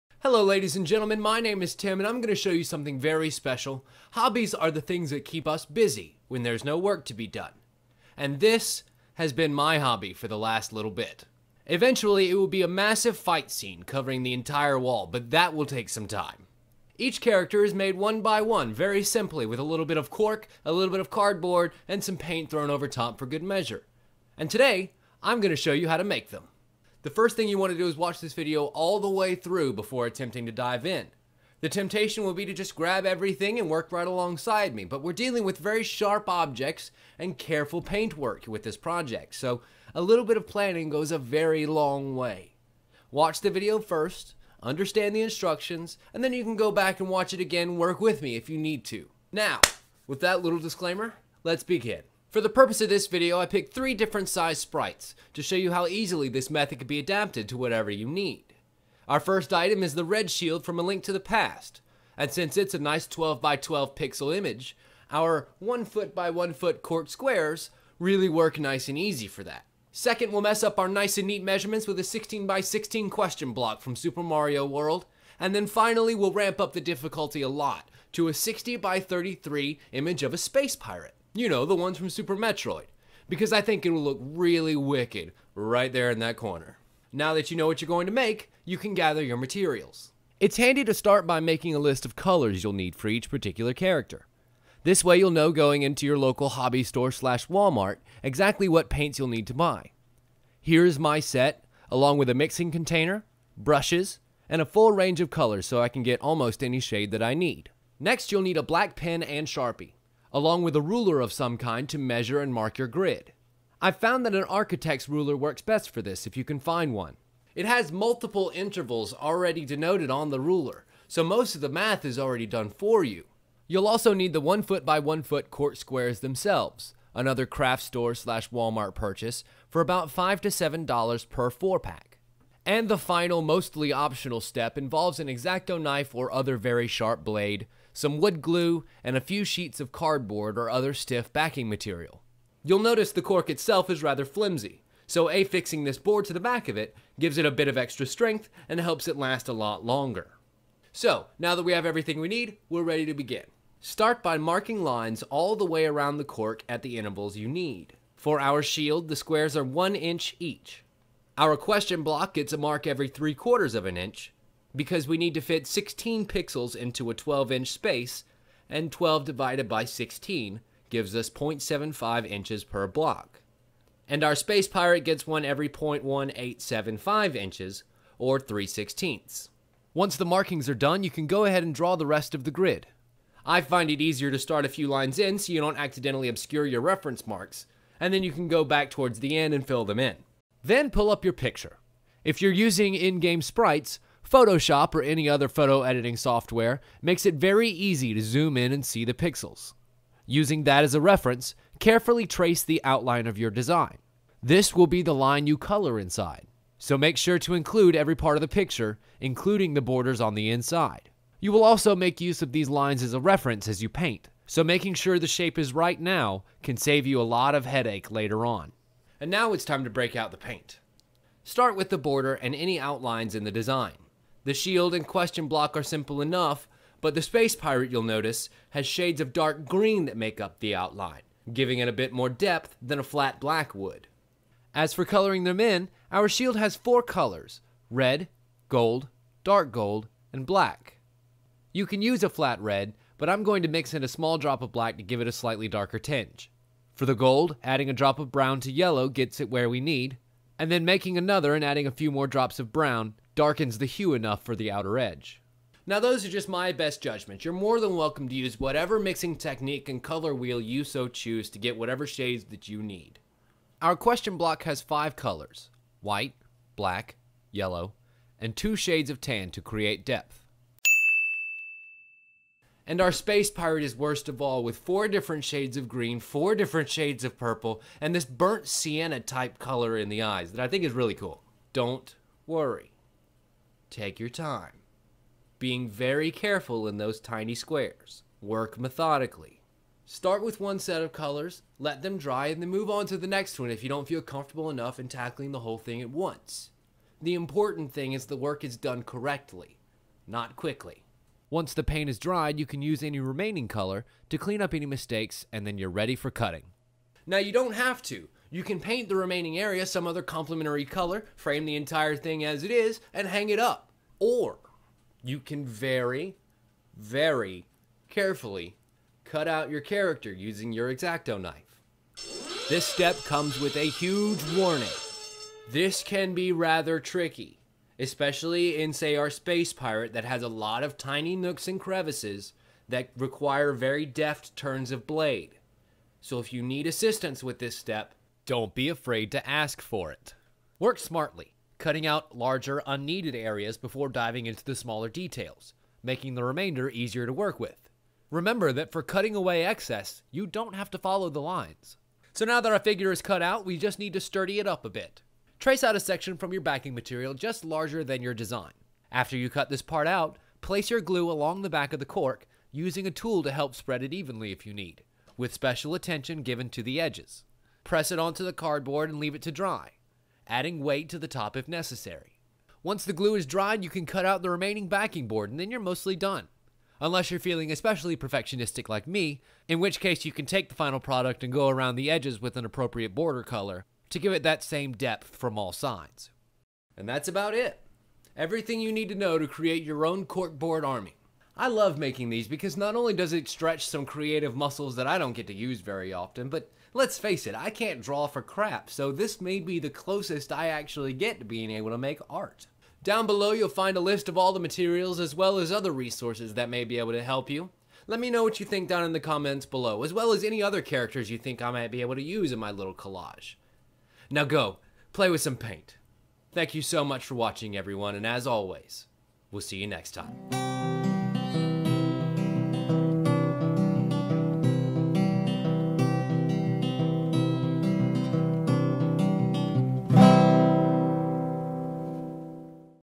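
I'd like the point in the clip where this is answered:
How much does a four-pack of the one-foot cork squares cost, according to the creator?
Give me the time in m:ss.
2:10.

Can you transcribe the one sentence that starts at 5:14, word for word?
Or you can very, very carefully cut out your character using your X-Acto knife.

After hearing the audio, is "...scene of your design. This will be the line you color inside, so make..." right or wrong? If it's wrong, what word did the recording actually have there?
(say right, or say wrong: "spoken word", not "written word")
wrong: "outline", not "scene".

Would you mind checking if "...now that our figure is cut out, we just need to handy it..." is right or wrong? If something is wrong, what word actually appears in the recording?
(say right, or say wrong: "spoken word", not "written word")
wrong: "sturdy", not "handy".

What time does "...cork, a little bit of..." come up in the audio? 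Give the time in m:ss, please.
0:20.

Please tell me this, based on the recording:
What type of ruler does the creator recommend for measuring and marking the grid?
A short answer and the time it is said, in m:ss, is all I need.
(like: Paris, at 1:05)
architect's ruler, at 1:54.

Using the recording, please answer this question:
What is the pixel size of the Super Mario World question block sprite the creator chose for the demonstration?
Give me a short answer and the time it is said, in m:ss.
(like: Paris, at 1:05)
16 by 16, at 1:12.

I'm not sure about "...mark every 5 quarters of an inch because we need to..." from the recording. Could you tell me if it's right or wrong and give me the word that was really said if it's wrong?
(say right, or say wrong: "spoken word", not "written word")
wrong: "3", not "5".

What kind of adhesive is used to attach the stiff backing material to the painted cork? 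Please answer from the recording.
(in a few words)
wood glue.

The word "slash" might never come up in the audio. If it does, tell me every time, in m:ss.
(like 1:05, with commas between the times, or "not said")
1:37, 2:08.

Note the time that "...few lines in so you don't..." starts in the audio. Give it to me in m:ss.
3:04.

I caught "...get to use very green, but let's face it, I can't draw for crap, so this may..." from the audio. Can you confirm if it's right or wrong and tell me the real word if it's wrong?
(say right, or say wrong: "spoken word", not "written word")
wrong: "often", not "green".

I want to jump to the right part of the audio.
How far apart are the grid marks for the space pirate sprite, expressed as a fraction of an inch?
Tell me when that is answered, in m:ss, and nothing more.
2:58.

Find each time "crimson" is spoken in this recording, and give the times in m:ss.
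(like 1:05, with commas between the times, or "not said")
not said.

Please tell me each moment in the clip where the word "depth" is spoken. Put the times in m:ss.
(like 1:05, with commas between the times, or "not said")
3:52, 4:30, 6:24.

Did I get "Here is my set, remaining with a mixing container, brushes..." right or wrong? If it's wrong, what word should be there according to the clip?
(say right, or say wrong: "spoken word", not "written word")
wrong: "along", not "remaining".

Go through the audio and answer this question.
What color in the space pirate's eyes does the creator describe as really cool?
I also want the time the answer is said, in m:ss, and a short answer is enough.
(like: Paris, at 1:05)
burnt sienna, at 4:38.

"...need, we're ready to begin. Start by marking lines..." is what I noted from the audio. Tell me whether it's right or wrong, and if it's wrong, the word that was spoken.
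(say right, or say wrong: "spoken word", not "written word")
right.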